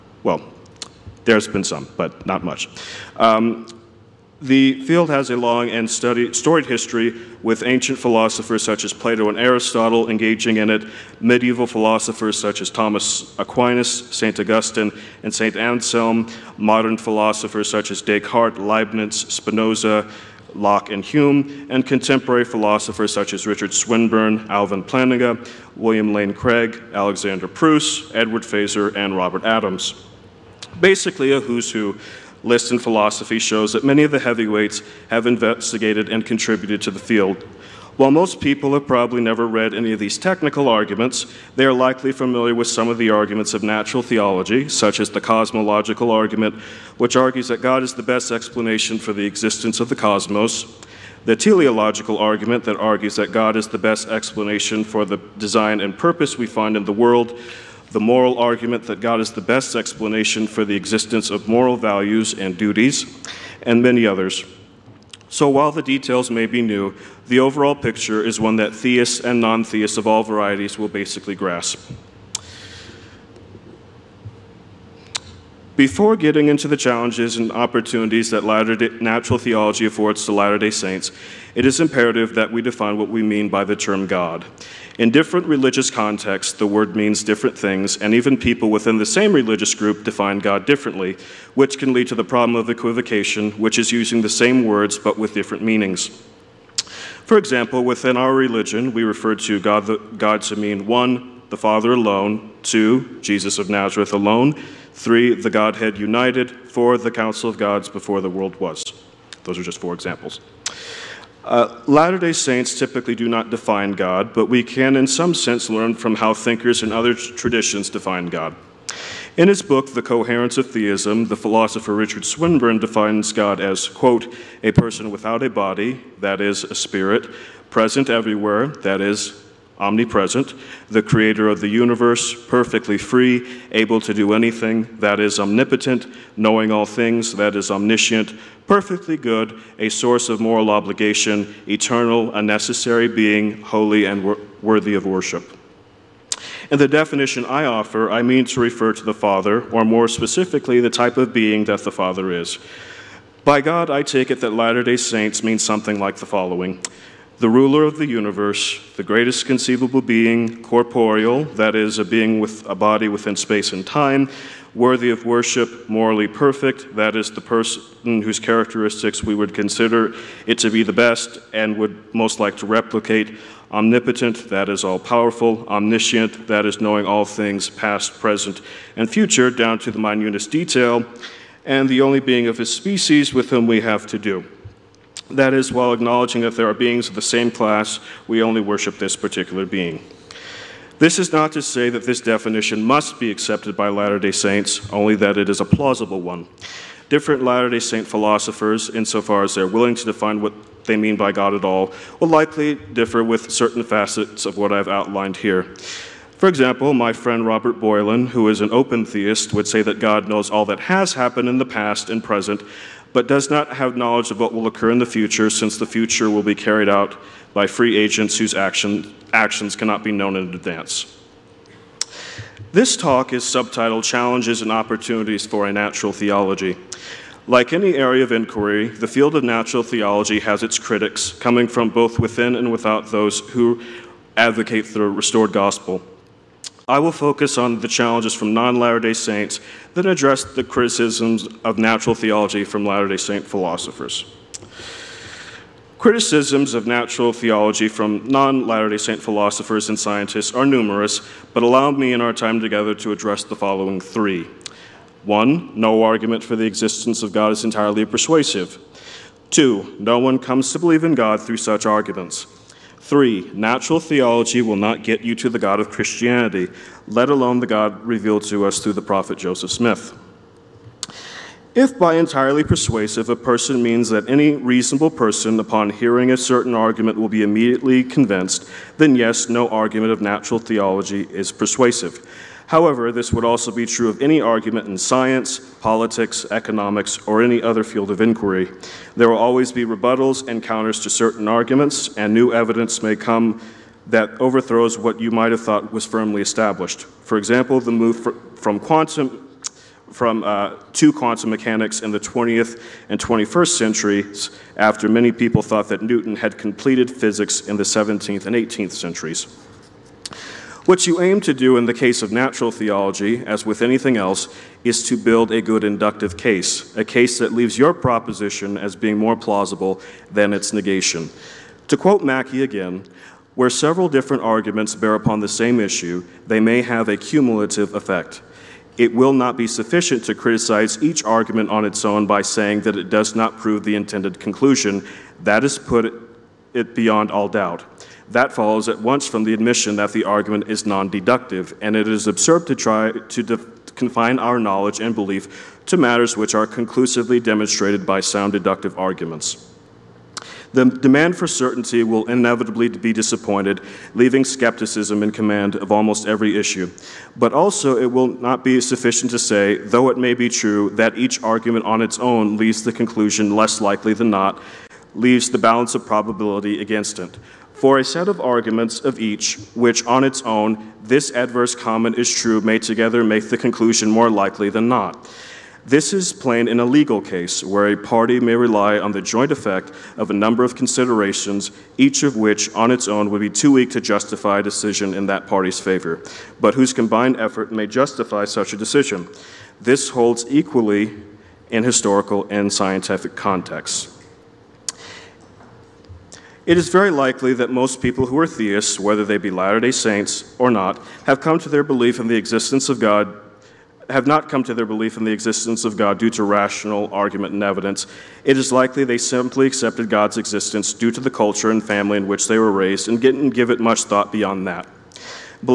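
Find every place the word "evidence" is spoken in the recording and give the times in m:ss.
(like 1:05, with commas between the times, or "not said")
4:52, 6:47.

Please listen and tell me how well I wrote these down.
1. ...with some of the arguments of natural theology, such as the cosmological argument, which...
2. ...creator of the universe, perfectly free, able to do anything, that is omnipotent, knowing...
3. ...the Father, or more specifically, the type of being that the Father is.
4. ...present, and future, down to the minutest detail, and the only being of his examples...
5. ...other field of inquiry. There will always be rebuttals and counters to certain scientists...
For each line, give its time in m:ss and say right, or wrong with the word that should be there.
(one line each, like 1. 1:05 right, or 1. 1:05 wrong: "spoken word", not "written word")
1. 0:42 right
2. 2:11 right
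3. 2:29 right
4. 2:58 wrong: "species", not "examples"
5. 4:47 wrong: "arguments", not "scientists".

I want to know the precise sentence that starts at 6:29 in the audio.
This holds equally in historical and scientific contexts.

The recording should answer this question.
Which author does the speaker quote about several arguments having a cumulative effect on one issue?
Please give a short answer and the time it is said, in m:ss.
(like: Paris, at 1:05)
Mackie, at 5:22.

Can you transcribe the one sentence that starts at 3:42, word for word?
This talk is subtitled Challenges and Opportunities for a Natural Theology.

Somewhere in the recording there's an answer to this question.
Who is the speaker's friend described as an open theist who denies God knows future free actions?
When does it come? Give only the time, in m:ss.
3:27.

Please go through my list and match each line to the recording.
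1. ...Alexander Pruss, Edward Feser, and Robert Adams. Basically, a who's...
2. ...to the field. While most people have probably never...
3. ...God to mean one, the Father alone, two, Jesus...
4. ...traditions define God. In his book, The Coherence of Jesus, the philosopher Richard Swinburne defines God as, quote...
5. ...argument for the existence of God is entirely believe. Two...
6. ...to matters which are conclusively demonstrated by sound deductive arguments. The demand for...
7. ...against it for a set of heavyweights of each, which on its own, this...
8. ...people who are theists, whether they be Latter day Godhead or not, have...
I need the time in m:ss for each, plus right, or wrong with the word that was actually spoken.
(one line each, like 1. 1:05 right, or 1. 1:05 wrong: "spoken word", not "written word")
1. 0:26 right
2. 0:36 right
3. 1:40 right
4. 1:57 wrong: "Theism", not "Jesus"
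5. 4:16 wrong: "persuasive", not "believe"
6. 5:45 right
7. 6:06 wrong: "arguments", not "heavyweights"
8. 6:37 wrong: "Saints", not "Godhead".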